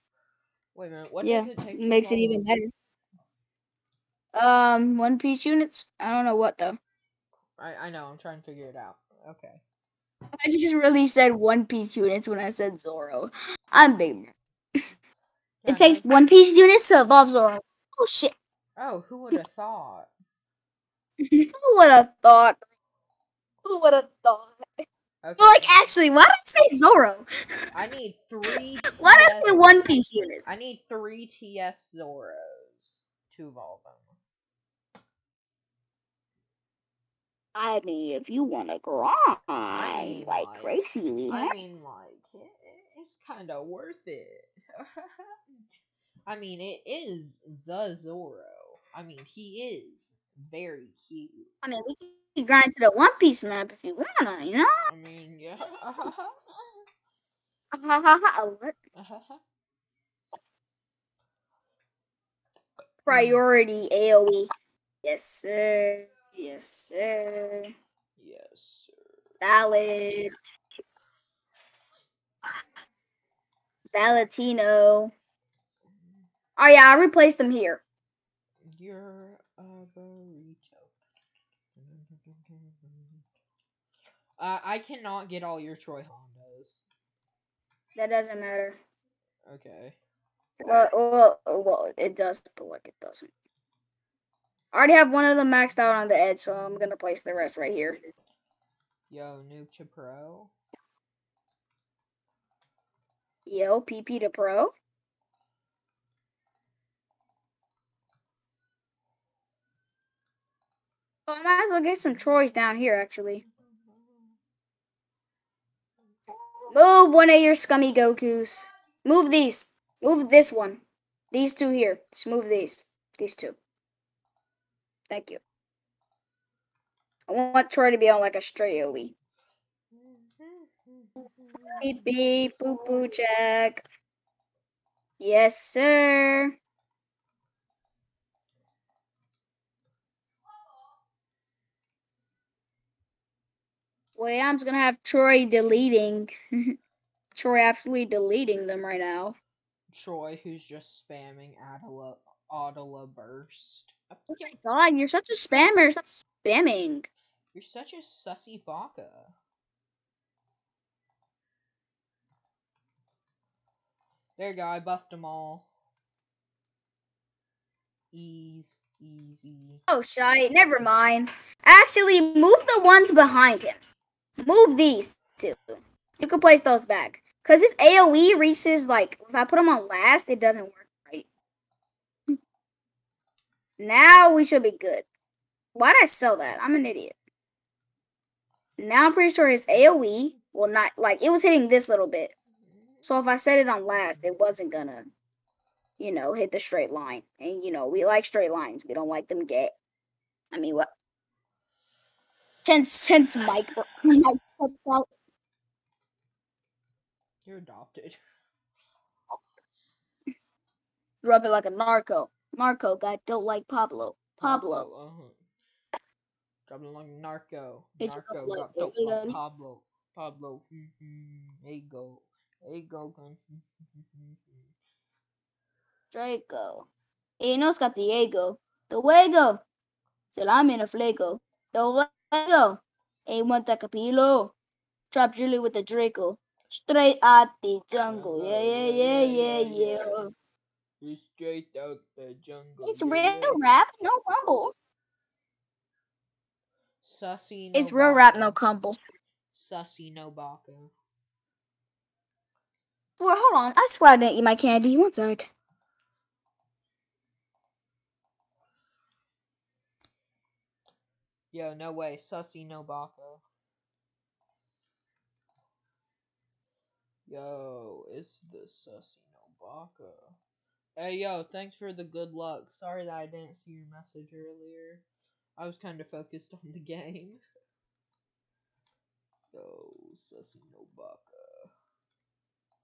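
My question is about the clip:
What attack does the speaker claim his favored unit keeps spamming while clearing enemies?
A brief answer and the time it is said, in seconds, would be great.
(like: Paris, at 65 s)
Adela Burst, at 152 s.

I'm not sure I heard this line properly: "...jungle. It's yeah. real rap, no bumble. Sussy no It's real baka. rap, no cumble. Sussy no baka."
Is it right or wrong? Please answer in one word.
right.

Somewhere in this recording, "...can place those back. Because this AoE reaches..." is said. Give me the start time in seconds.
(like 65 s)
176 s.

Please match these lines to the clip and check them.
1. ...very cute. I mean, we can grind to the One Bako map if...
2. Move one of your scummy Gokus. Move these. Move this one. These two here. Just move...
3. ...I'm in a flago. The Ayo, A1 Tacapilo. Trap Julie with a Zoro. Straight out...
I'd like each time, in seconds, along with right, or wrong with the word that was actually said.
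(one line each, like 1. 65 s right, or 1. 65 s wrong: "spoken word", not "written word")
1. 50 s wrong: "Piece", not "Bako"
2. 116 s right
3. 230 s wrong: "Draco", not "Zoro".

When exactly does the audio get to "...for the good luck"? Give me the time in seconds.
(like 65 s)
271 s.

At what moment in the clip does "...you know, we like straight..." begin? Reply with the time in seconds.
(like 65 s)
197 s.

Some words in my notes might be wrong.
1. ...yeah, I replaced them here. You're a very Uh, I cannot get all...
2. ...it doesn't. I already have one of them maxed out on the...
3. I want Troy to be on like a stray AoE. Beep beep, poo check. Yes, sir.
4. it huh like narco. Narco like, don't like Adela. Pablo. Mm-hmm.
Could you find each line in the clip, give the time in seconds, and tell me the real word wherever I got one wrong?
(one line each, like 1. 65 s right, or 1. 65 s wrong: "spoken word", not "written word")
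1. 76 s right
2. 92 s right
3. 127 s right
4. 215 s wrong: "Pablo", not "Adela".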